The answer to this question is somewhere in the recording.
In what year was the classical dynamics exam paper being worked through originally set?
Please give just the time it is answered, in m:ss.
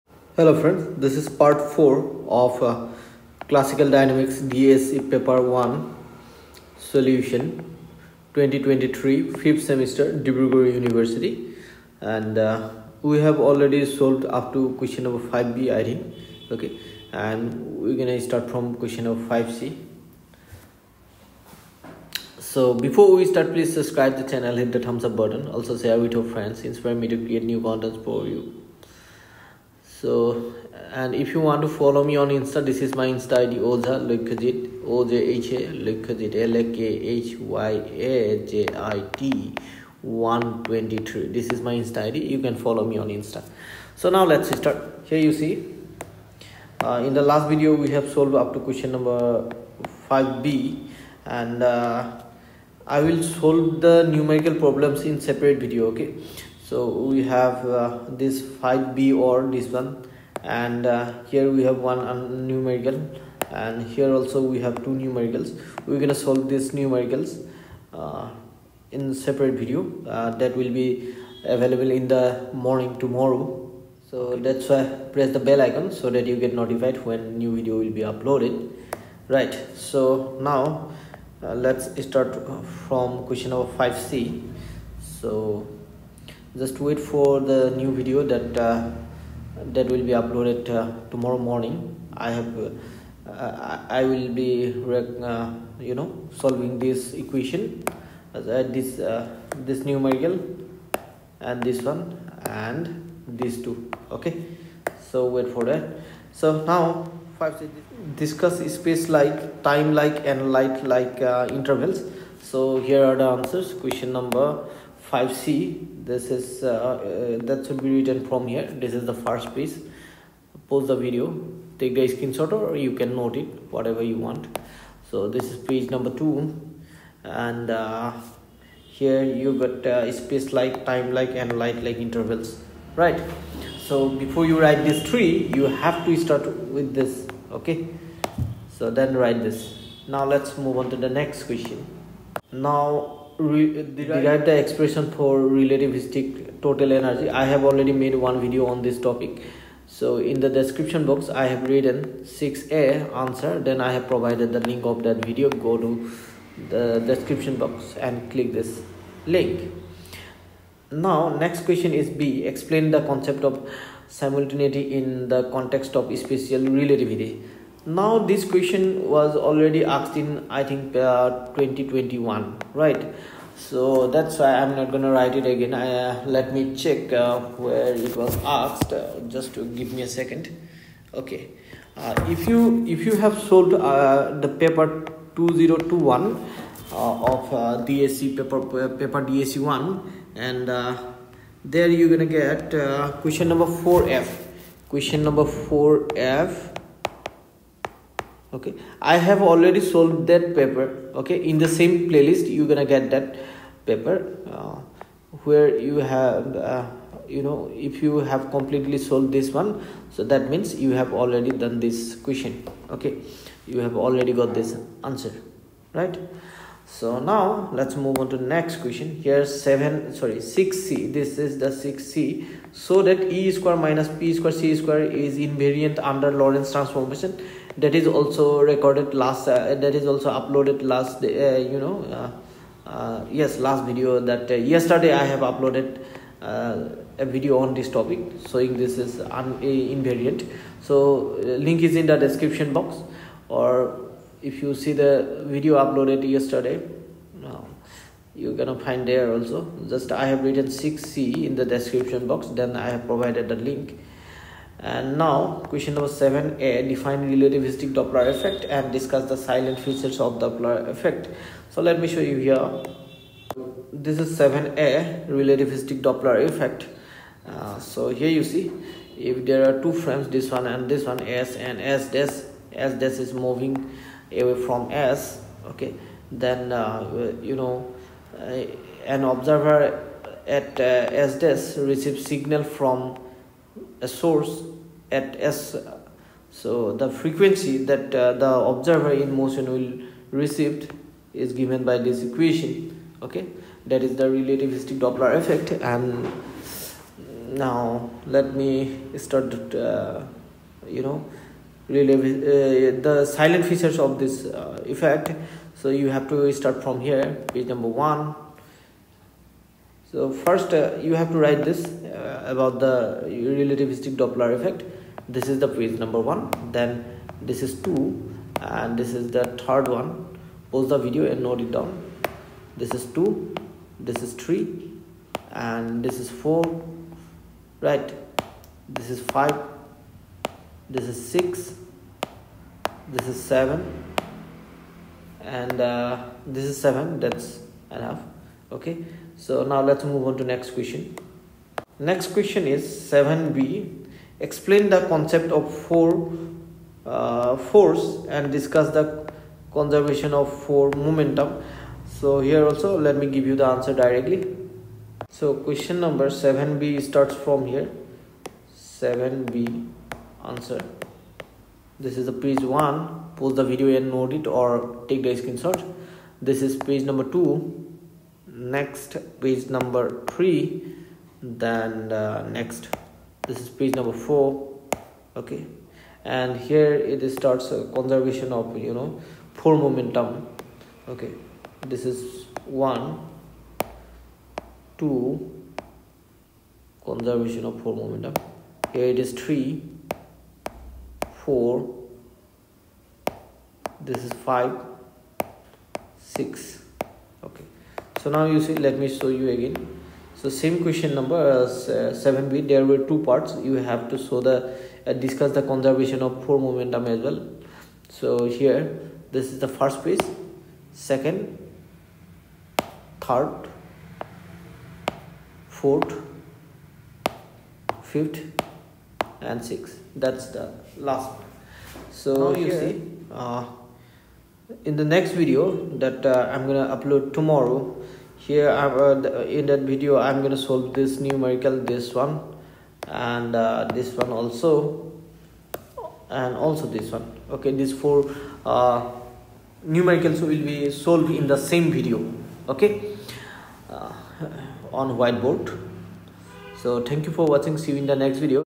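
0:08.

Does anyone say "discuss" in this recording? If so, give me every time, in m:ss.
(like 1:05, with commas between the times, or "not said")
1:48, 4:18, 5:48, 6:45.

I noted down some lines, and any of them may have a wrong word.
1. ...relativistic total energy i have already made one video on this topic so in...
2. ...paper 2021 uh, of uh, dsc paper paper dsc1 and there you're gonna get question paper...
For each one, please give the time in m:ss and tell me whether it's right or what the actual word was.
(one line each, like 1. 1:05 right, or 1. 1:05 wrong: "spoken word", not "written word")
1. 2:25 right
2. 3:04 wrong: "number", not "paper".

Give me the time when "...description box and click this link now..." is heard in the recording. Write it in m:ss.
2:37.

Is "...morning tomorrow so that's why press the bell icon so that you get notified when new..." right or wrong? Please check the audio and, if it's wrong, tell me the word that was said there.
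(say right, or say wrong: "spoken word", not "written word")
right.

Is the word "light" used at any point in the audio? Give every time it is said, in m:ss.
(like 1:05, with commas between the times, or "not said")
1:50, 2:11.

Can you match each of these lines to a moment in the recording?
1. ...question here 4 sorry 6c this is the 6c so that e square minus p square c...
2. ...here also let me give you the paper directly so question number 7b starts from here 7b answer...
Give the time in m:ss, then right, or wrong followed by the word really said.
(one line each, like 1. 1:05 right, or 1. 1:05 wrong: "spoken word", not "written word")
1. 3:38 wrong: "7", not "4"
2. 5:52 wrong: "answer", not "paper".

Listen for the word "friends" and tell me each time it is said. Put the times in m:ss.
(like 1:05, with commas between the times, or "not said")
0:00, 0:26.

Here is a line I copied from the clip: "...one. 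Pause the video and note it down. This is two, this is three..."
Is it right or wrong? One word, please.
right.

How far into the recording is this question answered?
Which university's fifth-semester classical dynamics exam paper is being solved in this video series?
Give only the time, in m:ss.
0:10.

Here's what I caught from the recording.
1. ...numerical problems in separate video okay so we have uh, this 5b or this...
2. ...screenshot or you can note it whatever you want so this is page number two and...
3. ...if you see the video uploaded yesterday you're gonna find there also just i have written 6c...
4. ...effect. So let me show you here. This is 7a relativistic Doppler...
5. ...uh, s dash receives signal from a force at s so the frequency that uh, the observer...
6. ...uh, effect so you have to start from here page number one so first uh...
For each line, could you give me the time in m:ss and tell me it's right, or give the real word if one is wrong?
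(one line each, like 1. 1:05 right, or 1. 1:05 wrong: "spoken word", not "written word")
1. 0:54 right
2. 2:02 right
3. 4:04 right
4. 4:20 right
5. 4:40 wrong: "source", not "force"
6. 5:04 right.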